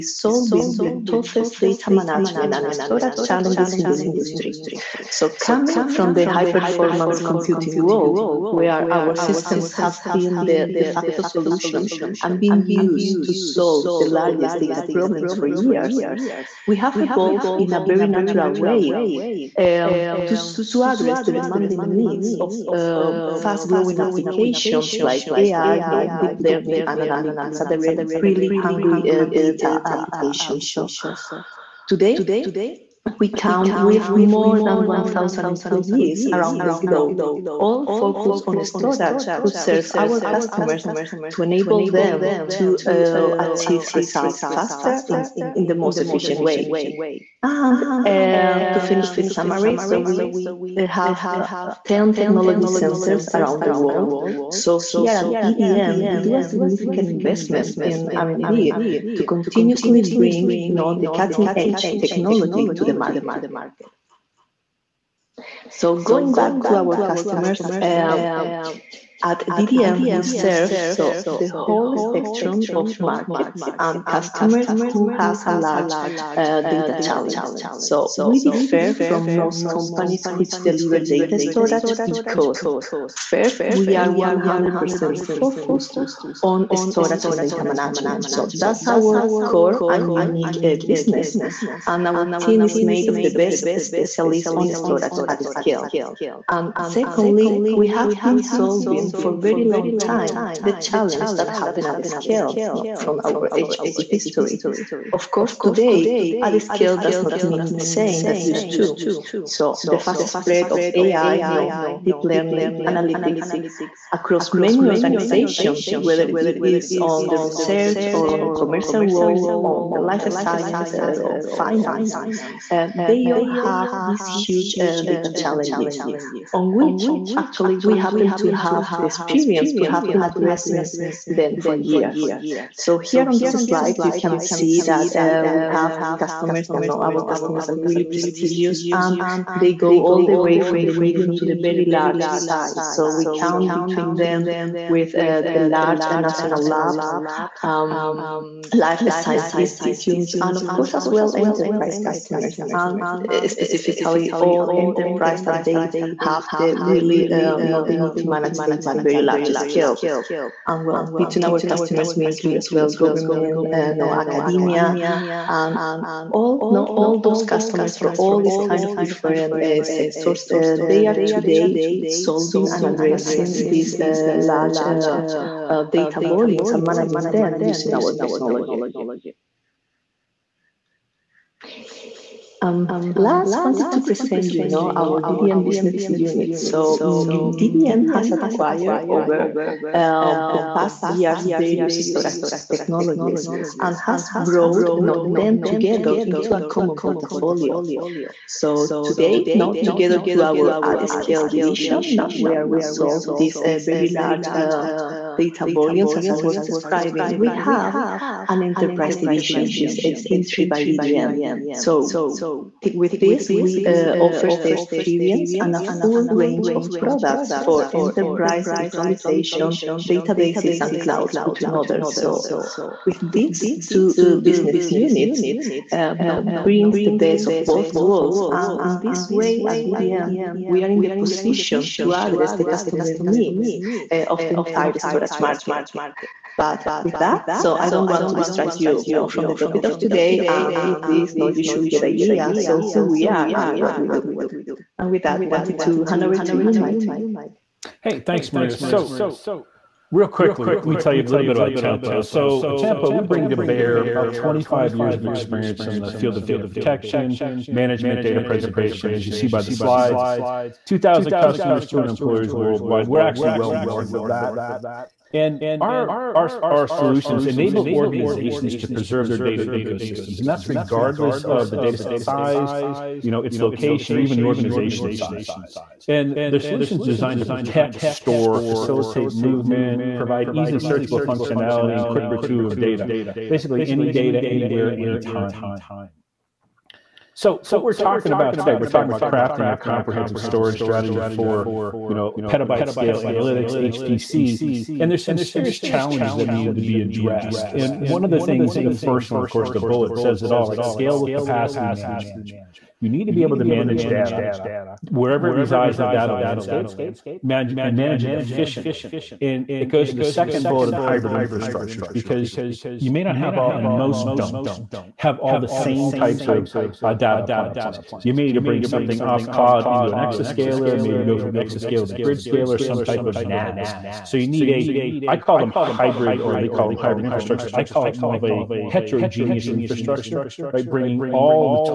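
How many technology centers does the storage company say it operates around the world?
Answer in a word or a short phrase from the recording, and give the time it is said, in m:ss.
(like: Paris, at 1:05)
10, at 0:51.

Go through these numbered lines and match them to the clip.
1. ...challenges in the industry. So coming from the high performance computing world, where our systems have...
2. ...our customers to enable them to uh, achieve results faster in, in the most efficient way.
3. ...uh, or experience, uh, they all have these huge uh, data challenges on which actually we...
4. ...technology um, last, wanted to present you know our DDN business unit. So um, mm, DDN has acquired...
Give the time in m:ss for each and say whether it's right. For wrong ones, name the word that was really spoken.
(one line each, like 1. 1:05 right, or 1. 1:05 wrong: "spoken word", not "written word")
1. 0:03 right
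2. 0:39 right
3. 2:00 wrong: "finance", not "experience"
4. 2:58 right.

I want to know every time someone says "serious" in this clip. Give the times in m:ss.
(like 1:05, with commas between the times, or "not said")
4:55.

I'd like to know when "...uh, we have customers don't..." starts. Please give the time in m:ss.
2:15.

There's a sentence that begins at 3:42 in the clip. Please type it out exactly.
So, with these two uh, business units, uh, you brings the best of both worlds.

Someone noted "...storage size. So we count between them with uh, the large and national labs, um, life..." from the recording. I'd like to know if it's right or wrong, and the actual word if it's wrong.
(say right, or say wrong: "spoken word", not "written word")
wrong: "large", not "storage".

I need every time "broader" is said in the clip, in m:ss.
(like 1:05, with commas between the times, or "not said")
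not said.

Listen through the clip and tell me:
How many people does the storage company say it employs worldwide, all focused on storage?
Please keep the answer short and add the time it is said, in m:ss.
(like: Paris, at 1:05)
More than 1,000, at 0:34.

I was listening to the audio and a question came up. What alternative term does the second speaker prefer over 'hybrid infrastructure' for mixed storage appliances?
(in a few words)
Heterogeneous infrastructure.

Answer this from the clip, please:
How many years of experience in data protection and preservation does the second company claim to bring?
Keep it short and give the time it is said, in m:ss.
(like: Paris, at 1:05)
About 25 years, at 4:14.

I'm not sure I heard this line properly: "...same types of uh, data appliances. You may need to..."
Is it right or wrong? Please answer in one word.
right.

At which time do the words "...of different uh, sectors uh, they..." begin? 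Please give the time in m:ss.
2:48.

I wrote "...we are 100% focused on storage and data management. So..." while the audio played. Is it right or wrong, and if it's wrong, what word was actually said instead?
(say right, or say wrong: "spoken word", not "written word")
right.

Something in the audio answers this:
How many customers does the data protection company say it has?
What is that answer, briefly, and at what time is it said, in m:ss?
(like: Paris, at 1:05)
2,000, at 4:20.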